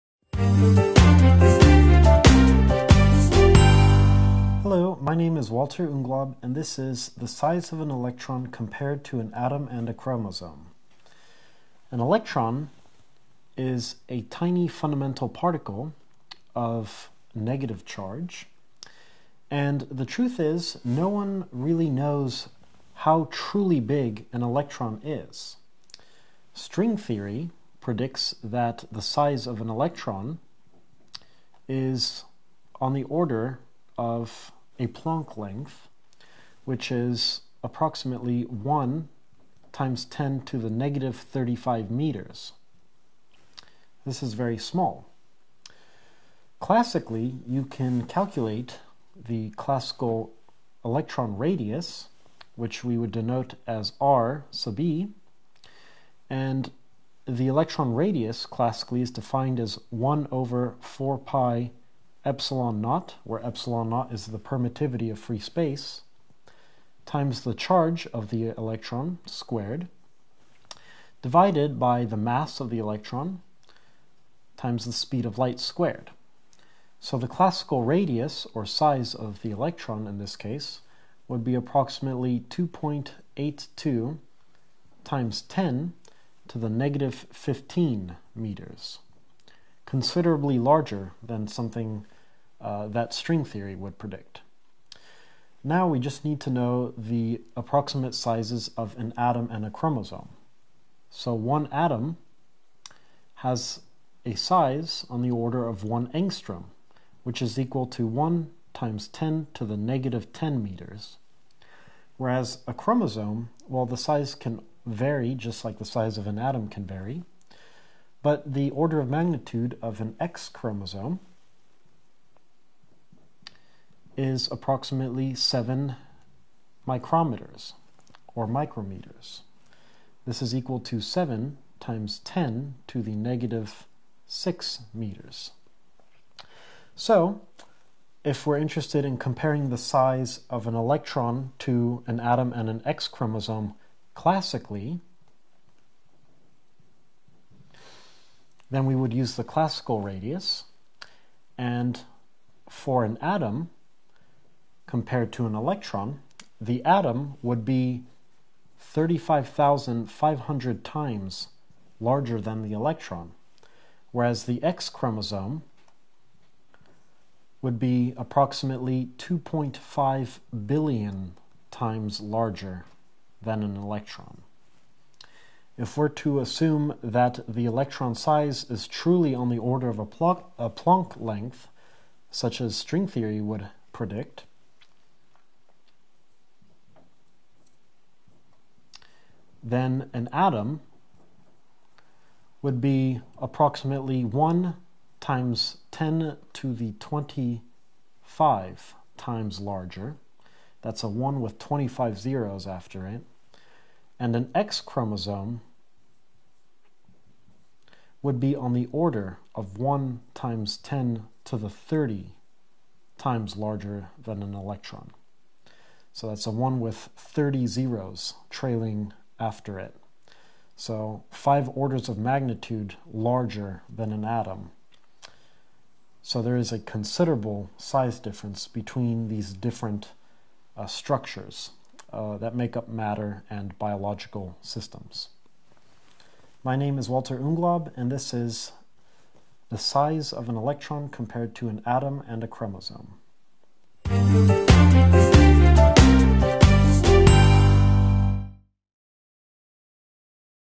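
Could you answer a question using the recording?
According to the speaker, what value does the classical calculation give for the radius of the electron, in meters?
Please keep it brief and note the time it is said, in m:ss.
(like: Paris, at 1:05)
2.82 x 10^-15 meters, at 1:22.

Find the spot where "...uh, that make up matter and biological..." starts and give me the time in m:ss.
3:52.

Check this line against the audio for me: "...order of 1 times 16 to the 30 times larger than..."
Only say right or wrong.
wrong.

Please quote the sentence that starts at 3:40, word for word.
So 5 orders of magnitude larger than an atom.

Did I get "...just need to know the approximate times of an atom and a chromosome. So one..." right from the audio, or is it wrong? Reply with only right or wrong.
wrong.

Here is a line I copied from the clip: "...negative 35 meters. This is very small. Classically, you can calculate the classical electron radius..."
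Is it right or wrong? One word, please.
right.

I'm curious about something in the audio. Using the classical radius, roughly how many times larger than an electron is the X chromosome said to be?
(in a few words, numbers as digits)
2.5 billion.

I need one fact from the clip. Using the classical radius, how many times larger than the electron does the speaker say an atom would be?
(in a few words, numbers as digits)
35,500.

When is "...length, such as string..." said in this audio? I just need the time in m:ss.
3:01.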